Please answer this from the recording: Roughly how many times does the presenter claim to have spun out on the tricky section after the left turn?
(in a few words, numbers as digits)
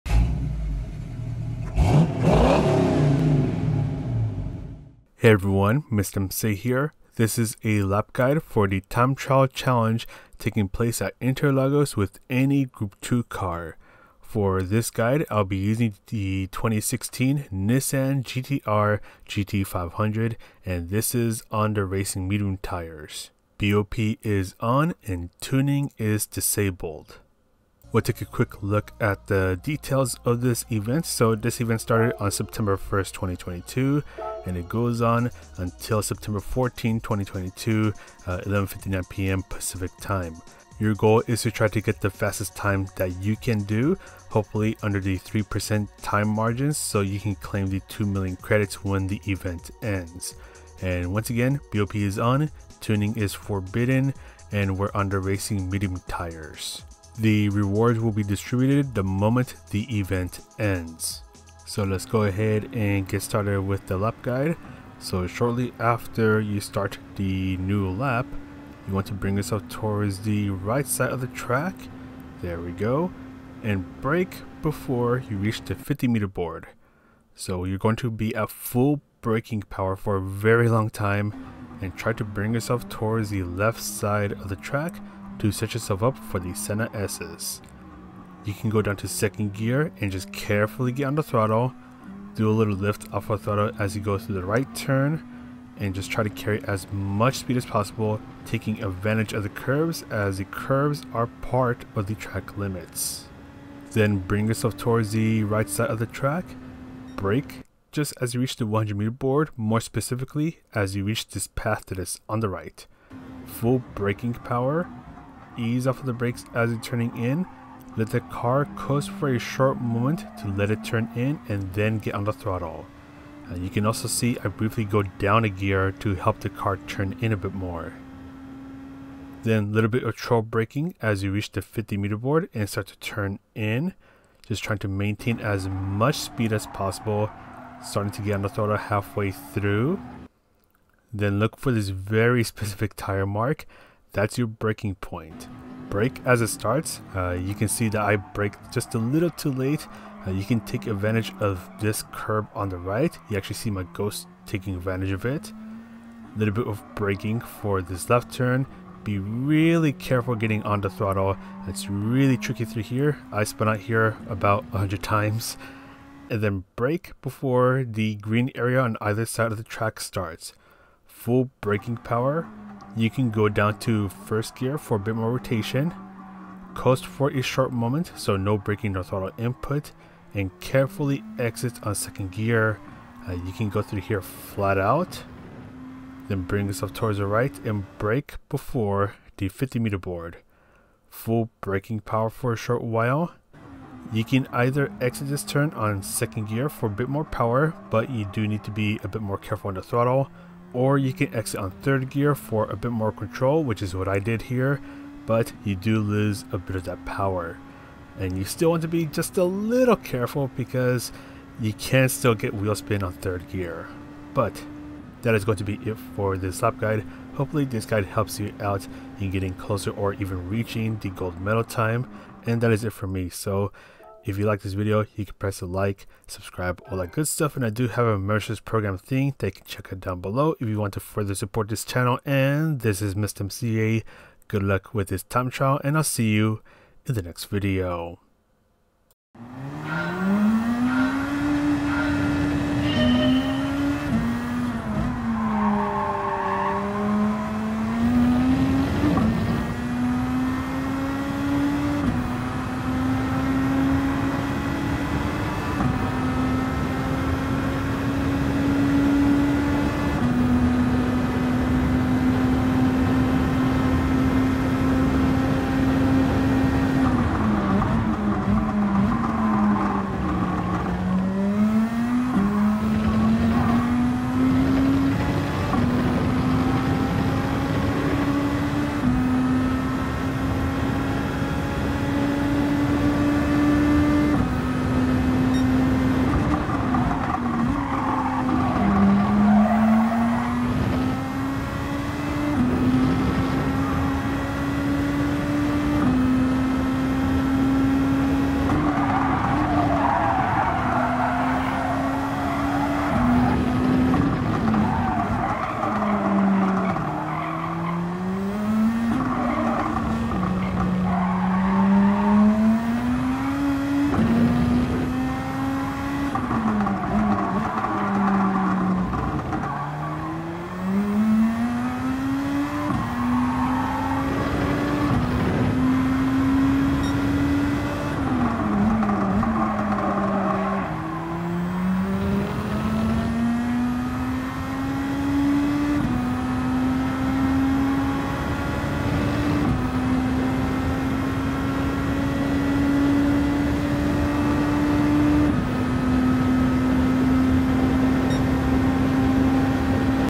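100.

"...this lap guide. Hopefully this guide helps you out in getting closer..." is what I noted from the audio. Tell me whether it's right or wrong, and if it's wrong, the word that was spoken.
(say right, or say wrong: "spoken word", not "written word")
right.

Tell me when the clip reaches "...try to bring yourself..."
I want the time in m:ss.
1:21.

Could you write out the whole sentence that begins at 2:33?
You actually see my ghost taking advantage of it.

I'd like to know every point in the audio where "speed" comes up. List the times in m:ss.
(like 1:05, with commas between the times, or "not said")
1:37, 2:16.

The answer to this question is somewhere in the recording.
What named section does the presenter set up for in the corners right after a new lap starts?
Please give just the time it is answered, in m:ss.
1:26.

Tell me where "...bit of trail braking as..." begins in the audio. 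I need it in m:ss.
2:09.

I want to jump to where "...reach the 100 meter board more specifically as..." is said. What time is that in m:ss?
1:48.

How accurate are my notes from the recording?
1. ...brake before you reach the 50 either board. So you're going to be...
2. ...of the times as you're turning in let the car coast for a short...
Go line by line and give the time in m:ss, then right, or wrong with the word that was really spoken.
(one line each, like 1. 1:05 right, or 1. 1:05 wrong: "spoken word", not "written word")
1. 1:14 wrong: "meter", not "either"
2. 1:55 wrong: "brakes", not "times".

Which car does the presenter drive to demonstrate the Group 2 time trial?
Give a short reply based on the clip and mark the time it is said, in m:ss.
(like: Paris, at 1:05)
2016 Nissan GTR GT500, at 0:16.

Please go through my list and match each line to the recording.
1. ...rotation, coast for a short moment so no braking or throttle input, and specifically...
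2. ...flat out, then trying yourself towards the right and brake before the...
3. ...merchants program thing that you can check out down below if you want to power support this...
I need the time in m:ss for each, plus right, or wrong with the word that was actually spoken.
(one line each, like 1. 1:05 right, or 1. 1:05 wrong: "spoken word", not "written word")
1. 2:55 wrong: "carefully", not "specifically"
2. 3:04 wrong: "bring", not "trying"
3. 3:48 wrong: "further", not "power".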